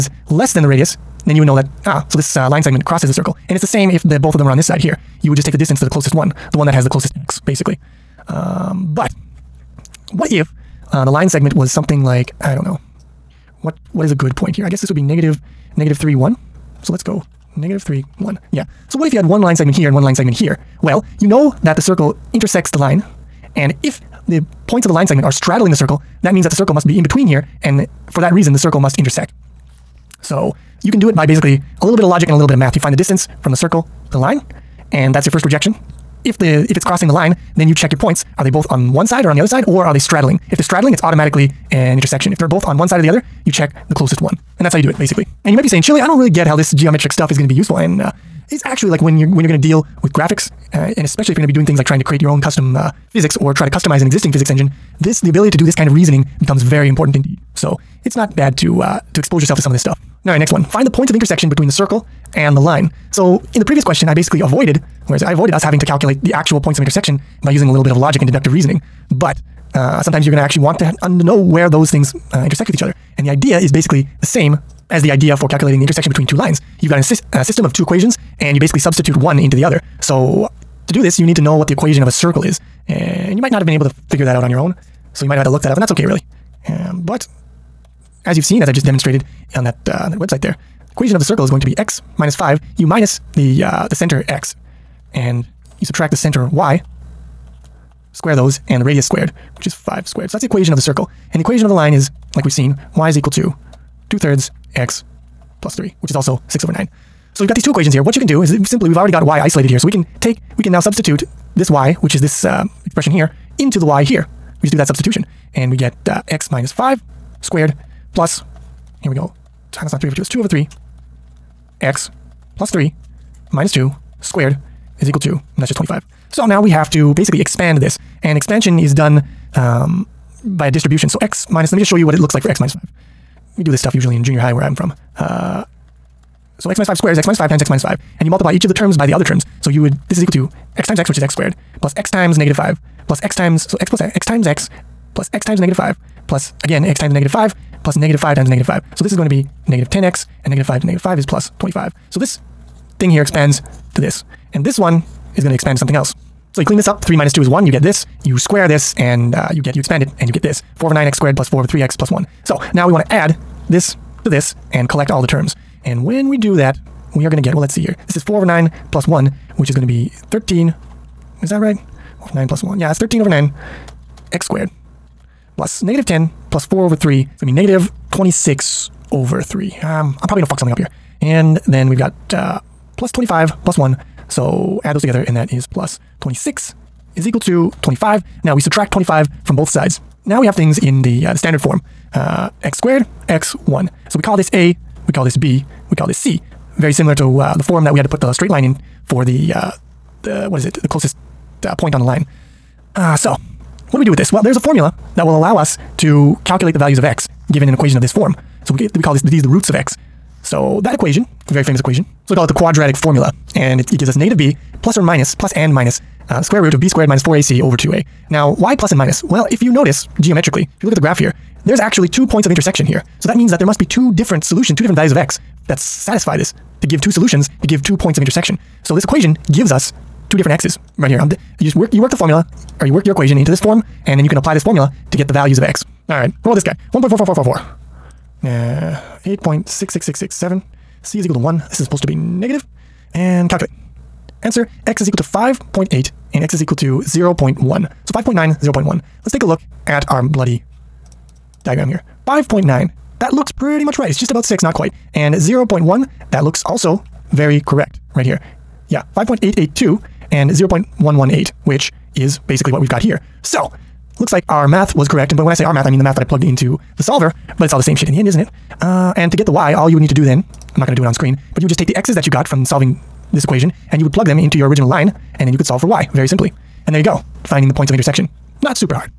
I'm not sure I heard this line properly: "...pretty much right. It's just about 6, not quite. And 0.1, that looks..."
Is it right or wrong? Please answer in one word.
right.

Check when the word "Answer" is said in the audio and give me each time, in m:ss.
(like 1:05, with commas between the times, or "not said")
4:04.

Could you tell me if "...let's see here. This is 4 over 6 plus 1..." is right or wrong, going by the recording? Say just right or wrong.
wrong.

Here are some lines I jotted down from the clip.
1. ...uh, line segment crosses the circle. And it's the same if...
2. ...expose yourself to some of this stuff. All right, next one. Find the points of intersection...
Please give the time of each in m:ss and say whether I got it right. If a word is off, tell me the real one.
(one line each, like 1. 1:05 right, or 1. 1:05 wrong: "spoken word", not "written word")
1. 0:02 right
2. 0:59 right.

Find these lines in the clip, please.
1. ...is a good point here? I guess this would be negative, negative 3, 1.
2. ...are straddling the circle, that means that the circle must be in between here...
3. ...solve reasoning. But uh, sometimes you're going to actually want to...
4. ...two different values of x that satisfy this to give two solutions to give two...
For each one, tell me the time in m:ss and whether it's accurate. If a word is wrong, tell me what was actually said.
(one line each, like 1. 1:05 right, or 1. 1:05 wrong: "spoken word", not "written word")
1. 0:14 right
2. 0:25 right
3. 1:08 wrong: "deductive", not "solve"
4. 3:44 right.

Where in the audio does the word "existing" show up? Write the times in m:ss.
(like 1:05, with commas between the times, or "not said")
0:54.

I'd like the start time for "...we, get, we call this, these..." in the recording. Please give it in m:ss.
3:28.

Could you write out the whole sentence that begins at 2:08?
And expansion is done um, by a distribution.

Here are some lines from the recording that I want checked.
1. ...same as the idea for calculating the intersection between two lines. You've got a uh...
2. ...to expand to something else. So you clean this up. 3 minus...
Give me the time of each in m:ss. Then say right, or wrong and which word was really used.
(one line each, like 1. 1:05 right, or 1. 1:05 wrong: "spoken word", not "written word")
1. 1:14 right
2. 2:35 right.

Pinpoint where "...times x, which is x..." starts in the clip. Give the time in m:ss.
2:20.